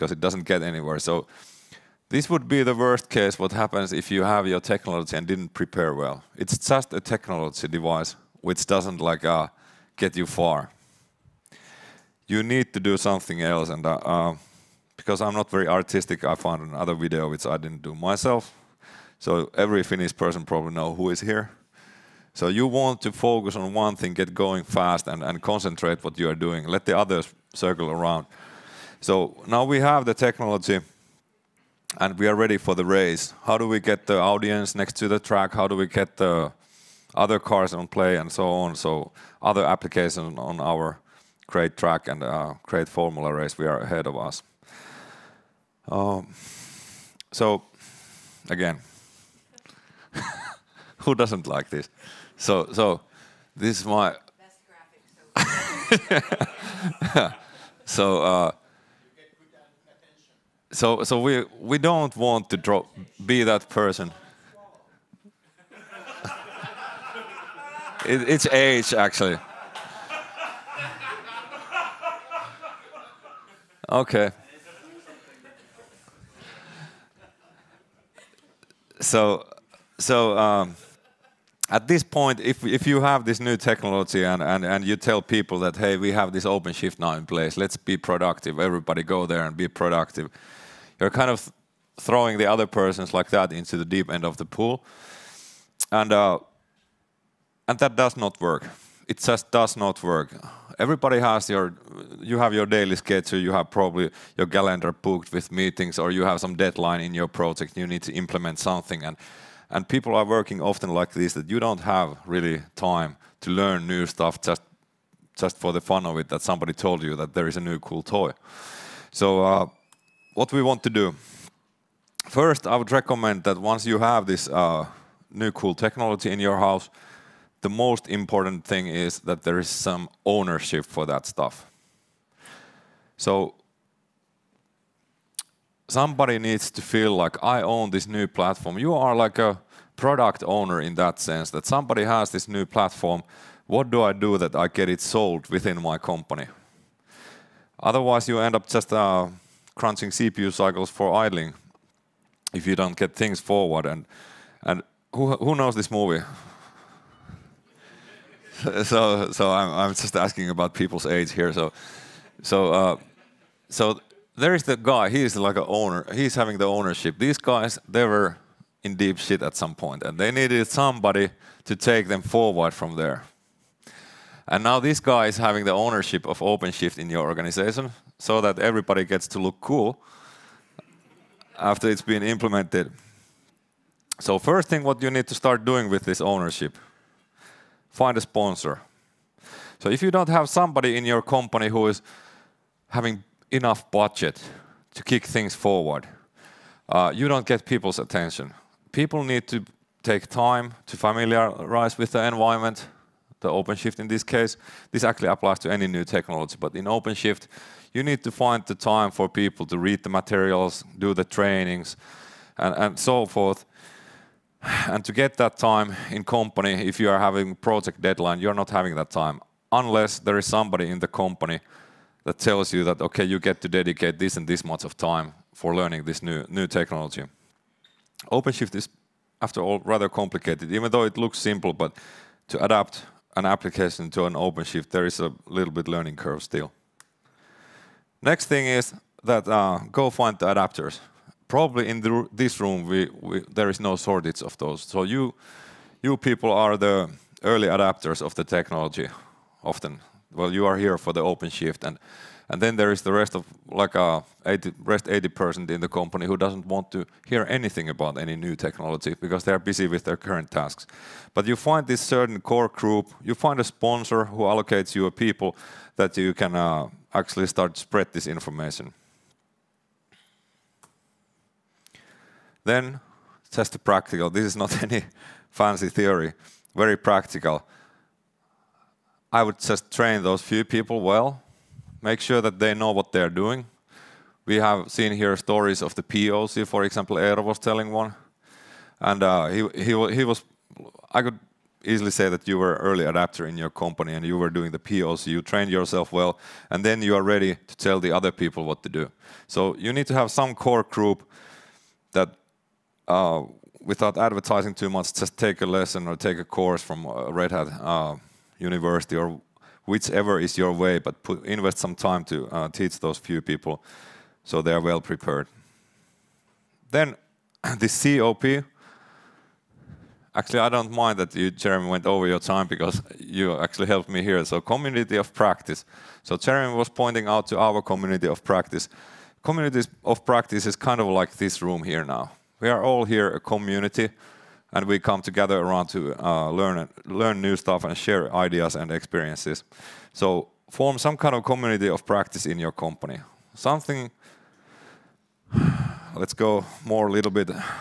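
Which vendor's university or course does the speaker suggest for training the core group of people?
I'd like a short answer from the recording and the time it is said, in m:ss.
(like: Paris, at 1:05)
Red Hat, at 5:07.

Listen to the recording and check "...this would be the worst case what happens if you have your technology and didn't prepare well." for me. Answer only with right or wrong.
right.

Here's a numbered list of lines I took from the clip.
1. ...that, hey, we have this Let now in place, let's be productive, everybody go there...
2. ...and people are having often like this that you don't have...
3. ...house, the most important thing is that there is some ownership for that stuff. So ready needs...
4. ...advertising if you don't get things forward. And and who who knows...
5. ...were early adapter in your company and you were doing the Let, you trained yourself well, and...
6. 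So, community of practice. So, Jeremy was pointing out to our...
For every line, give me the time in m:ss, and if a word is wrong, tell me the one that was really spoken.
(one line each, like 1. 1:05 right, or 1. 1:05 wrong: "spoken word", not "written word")
1. 1:25 wrong: "OpenShift", not "Let"
2. 1:49 wrong: "working", not "having"
3. 2:06 wrong: "somebody", not "ready"
4. 2:31 wrong: "idling", not "advertising"
5. 4:52 wrong: "POC", not "Let"
6. 5:24 right.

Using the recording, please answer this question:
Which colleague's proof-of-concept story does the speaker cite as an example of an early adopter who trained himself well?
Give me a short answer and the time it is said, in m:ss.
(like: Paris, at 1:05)
Eero, at 4:47.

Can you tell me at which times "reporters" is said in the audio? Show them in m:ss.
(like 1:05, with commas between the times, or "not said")
not said.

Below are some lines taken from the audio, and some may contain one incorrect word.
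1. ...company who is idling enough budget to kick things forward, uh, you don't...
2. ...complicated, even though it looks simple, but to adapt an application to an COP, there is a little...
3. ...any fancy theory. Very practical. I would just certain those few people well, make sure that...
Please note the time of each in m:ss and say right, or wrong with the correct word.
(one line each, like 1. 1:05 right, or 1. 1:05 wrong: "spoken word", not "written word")
1. 3:11 wrong: "having", not "idling"
2. 3:50 wrong: "OpenShift", not "COP"
3. 4:34 wrong: "train", not "certain".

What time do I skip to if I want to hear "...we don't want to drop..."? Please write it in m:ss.
1:01.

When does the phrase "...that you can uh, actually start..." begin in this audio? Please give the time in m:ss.
4:25.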